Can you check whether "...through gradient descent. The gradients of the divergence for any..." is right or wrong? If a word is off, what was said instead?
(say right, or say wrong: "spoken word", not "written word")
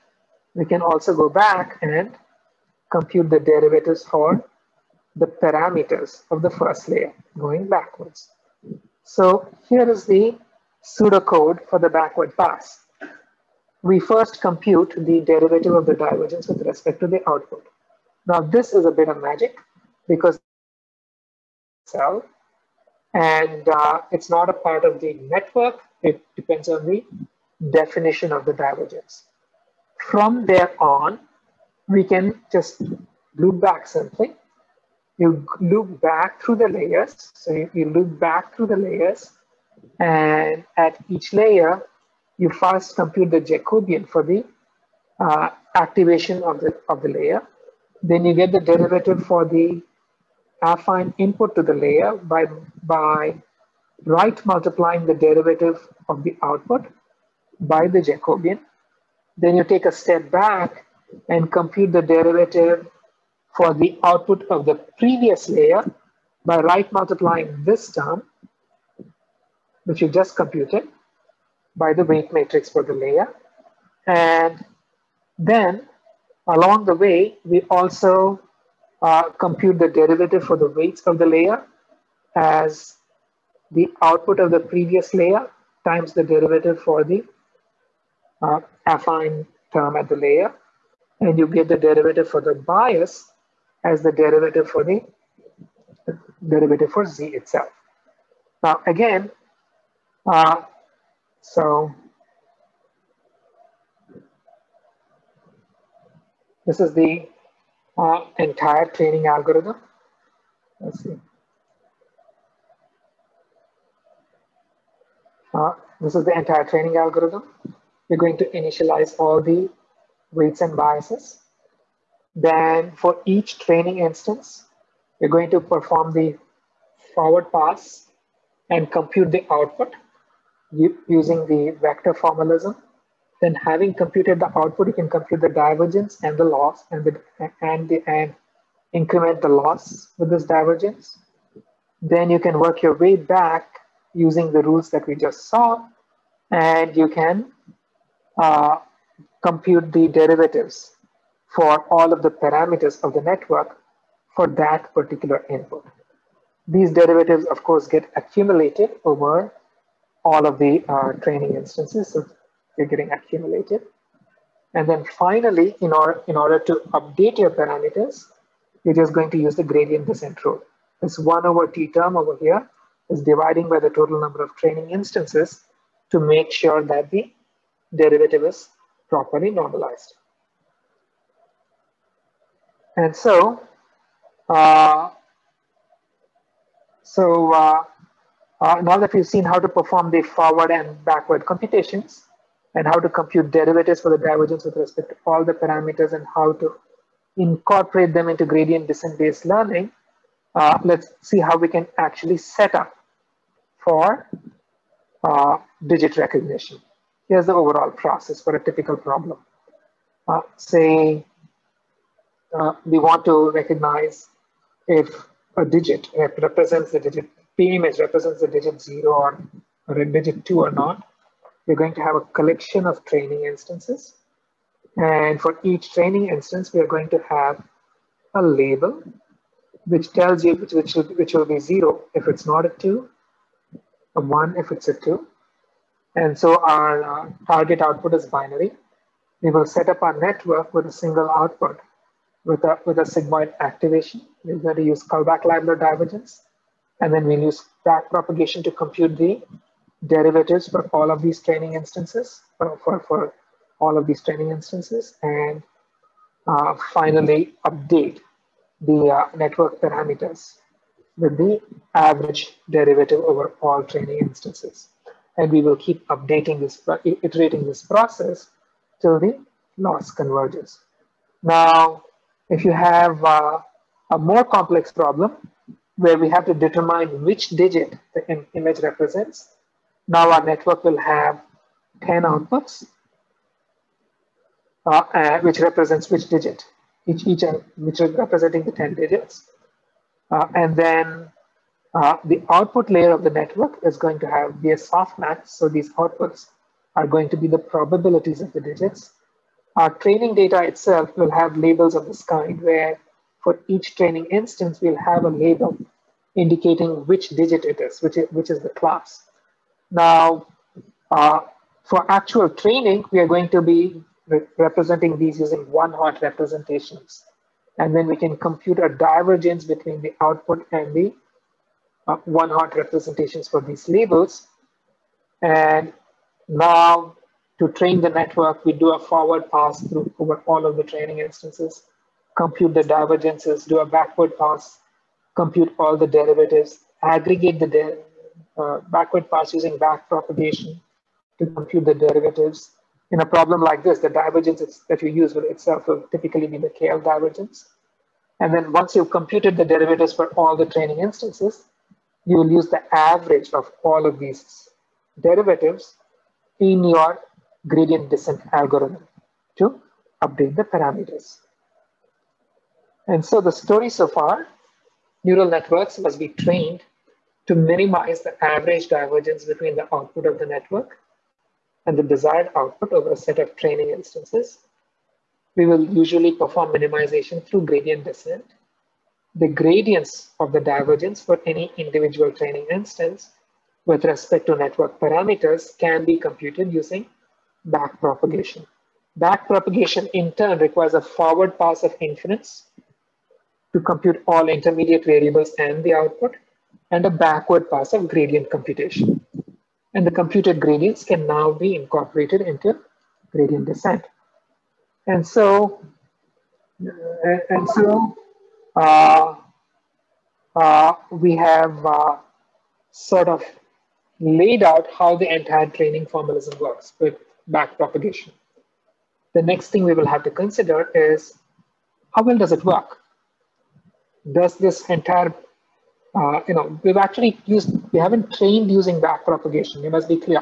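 right.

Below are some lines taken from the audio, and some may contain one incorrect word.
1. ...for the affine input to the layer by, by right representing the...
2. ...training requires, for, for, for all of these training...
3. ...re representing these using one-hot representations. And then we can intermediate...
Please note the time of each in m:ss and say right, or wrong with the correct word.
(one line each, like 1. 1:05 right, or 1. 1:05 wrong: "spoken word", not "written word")
1. 0:49 wrong: "multiplying", not "representing"
2. 4:11 wrong: "instances", not "requires"
3. 5:14 wrong: "compute", not "intermediate".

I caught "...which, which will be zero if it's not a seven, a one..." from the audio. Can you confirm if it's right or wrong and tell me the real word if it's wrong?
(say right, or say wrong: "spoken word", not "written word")
wrong: "two", not "seven".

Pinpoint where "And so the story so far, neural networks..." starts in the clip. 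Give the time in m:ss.
6:03.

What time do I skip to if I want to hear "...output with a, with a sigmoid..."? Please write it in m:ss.
4:01.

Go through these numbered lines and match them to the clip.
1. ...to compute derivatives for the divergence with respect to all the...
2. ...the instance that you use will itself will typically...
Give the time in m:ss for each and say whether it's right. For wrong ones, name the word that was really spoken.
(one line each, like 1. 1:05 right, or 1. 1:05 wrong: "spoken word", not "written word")
1. 3:12 right
2. 5:43 wrong: "divergence", not "instance".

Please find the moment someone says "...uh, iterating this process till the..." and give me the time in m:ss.
4:26.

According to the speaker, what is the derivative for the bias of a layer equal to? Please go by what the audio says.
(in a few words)
derivative for z.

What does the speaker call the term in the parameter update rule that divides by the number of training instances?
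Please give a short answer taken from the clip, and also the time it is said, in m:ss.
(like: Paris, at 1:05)
one over t, at 2:51.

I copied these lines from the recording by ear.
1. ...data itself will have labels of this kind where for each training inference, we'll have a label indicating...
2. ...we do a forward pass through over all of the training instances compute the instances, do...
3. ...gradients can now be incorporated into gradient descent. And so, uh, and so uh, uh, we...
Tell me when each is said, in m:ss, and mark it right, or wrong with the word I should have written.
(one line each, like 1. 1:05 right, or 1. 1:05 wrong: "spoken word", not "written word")
1. 5:00 wrong: "instance", not "inference"
2. 5:28 wrong: "divergences", not "instances"
3. 6:40 right.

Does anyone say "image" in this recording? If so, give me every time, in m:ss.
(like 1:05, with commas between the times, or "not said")
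3:37, 4:38.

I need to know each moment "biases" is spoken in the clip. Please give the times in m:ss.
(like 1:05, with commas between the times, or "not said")
2:00.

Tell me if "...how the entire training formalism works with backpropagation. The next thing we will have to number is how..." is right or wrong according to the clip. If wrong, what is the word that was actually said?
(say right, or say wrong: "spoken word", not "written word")
wrong: "consider", not "number".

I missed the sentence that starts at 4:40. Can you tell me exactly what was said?
Now our network will have 10 outputs, uh, uh, which represents which digit, each, each uh, which are representing the 10 digits.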